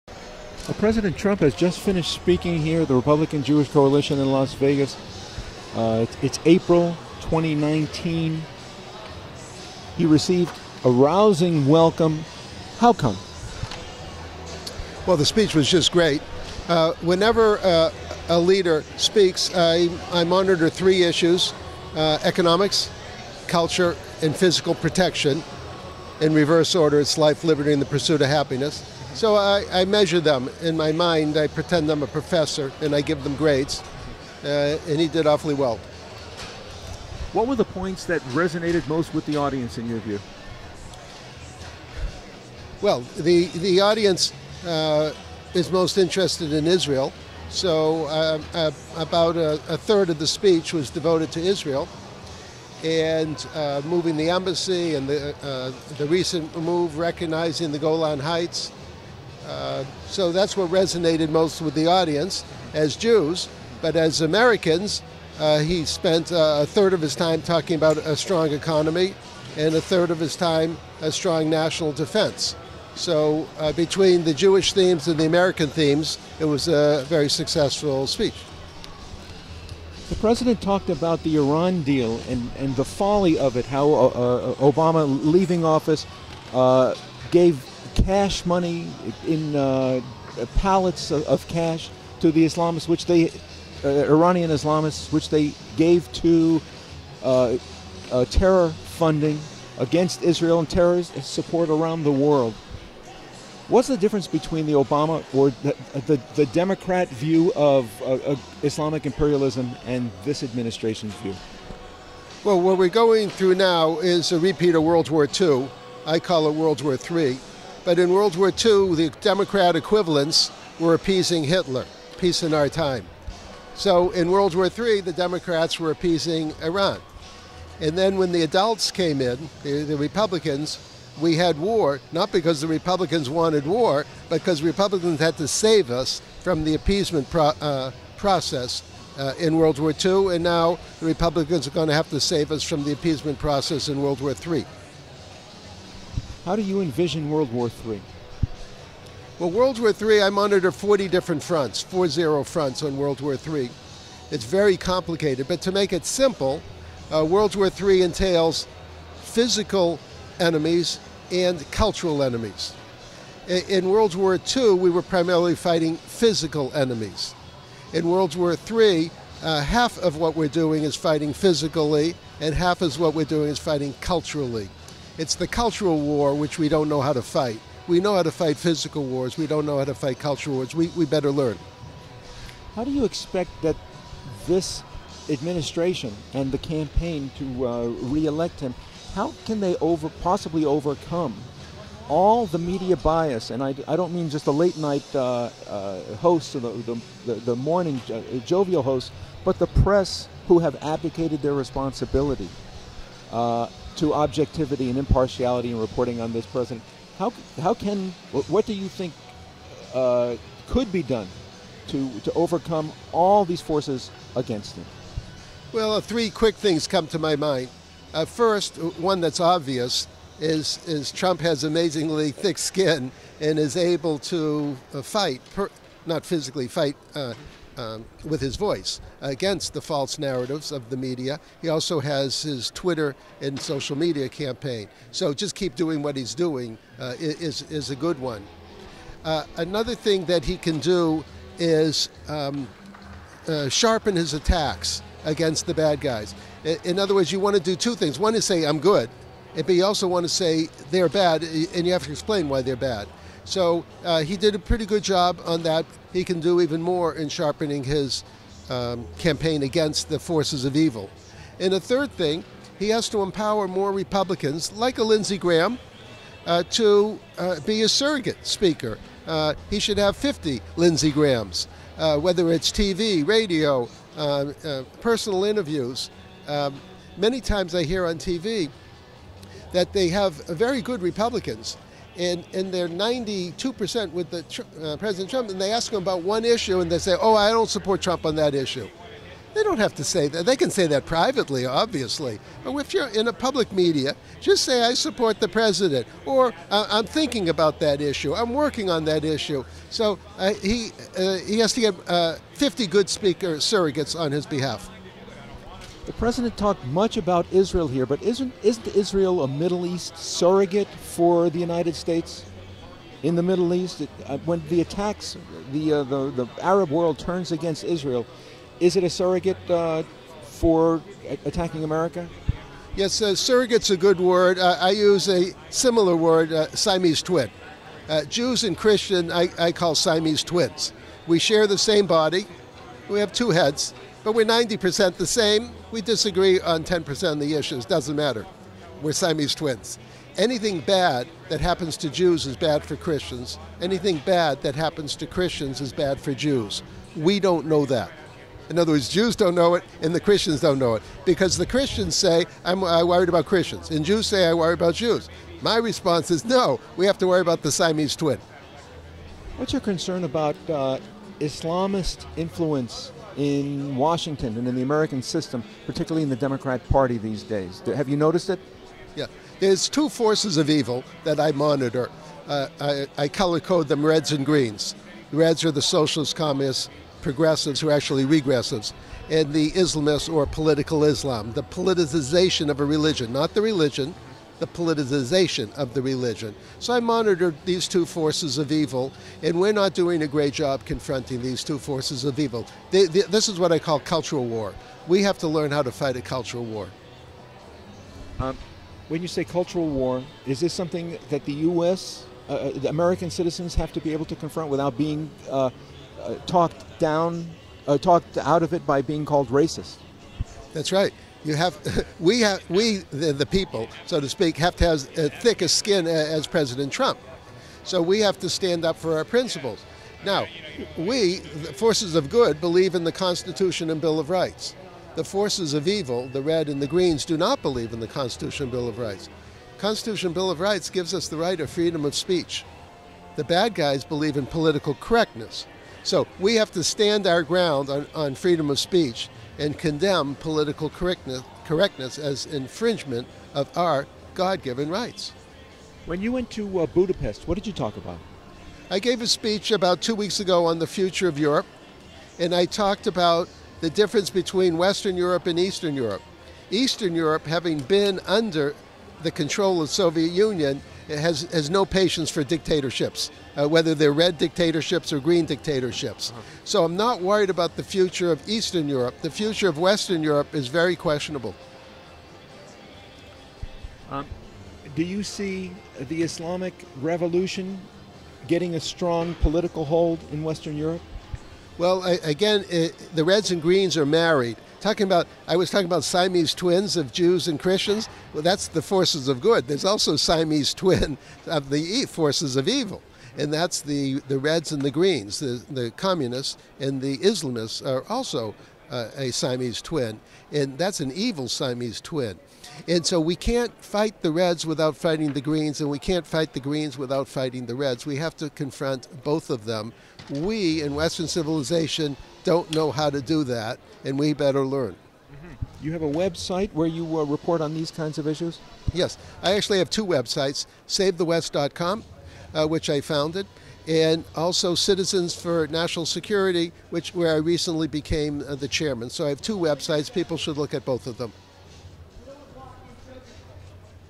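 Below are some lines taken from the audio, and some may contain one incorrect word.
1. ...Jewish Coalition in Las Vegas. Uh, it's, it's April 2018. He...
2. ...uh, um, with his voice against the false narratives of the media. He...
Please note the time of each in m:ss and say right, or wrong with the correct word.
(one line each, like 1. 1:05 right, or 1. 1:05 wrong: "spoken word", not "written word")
1. 0:03 wrong: "2019", not "2018"
2. 3:47 right.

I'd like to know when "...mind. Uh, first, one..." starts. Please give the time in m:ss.
3:37.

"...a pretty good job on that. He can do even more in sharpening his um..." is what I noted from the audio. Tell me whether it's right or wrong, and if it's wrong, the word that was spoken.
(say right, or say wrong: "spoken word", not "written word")
right.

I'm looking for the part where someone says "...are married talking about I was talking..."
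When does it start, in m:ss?
8:03.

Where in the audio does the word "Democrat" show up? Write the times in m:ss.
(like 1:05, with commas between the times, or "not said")
1:46, 1:59, 2:05, 6:06.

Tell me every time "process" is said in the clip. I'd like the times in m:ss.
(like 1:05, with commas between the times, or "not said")
2:18, 2:23.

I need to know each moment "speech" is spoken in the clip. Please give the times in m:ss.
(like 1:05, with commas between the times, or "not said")
0:15, 0:50, 1:18, 7:12, 7:18, 7:29.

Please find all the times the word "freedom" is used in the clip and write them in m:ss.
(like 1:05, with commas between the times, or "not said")
7:11, 7:18.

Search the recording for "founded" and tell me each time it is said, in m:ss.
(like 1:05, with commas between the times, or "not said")
8:43.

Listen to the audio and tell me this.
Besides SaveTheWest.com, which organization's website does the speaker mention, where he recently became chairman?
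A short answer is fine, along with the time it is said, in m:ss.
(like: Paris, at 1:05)
Citizens for National Security, at 8:44.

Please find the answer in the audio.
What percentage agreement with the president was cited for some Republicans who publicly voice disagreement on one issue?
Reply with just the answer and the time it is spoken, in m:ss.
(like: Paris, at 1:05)
92%, at 4:42.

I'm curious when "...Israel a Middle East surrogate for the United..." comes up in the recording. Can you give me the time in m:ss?
5:08.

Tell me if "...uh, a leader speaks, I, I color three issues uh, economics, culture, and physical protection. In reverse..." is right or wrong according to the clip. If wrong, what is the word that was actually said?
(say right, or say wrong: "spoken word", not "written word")
wrong: "monitor", not "color".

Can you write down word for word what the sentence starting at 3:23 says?
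Uh, to objectivity and impartiality in reporting on this president.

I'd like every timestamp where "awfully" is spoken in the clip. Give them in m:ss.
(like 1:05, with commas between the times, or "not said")
0:35.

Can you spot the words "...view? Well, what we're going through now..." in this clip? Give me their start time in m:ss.
1:51.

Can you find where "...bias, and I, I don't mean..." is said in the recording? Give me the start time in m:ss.
3:12.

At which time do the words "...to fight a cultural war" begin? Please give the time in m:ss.
6:35.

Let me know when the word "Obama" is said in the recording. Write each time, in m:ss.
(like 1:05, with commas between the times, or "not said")
1:24, 1:44.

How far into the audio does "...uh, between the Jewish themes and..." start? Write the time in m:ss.
1:13.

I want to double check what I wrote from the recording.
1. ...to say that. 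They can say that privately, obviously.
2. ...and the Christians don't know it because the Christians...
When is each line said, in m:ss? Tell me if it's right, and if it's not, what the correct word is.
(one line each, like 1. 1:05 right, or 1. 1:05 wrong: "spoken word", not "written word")
1. 4:49 right
2. 5:50 right.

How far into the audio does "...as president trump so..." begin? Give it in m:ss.
6:56.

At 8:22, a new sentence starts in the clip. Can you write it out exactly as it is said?
And so we can't fight the Reds without fighting the Greens, and we can't fight the Greens without fighting the Reds.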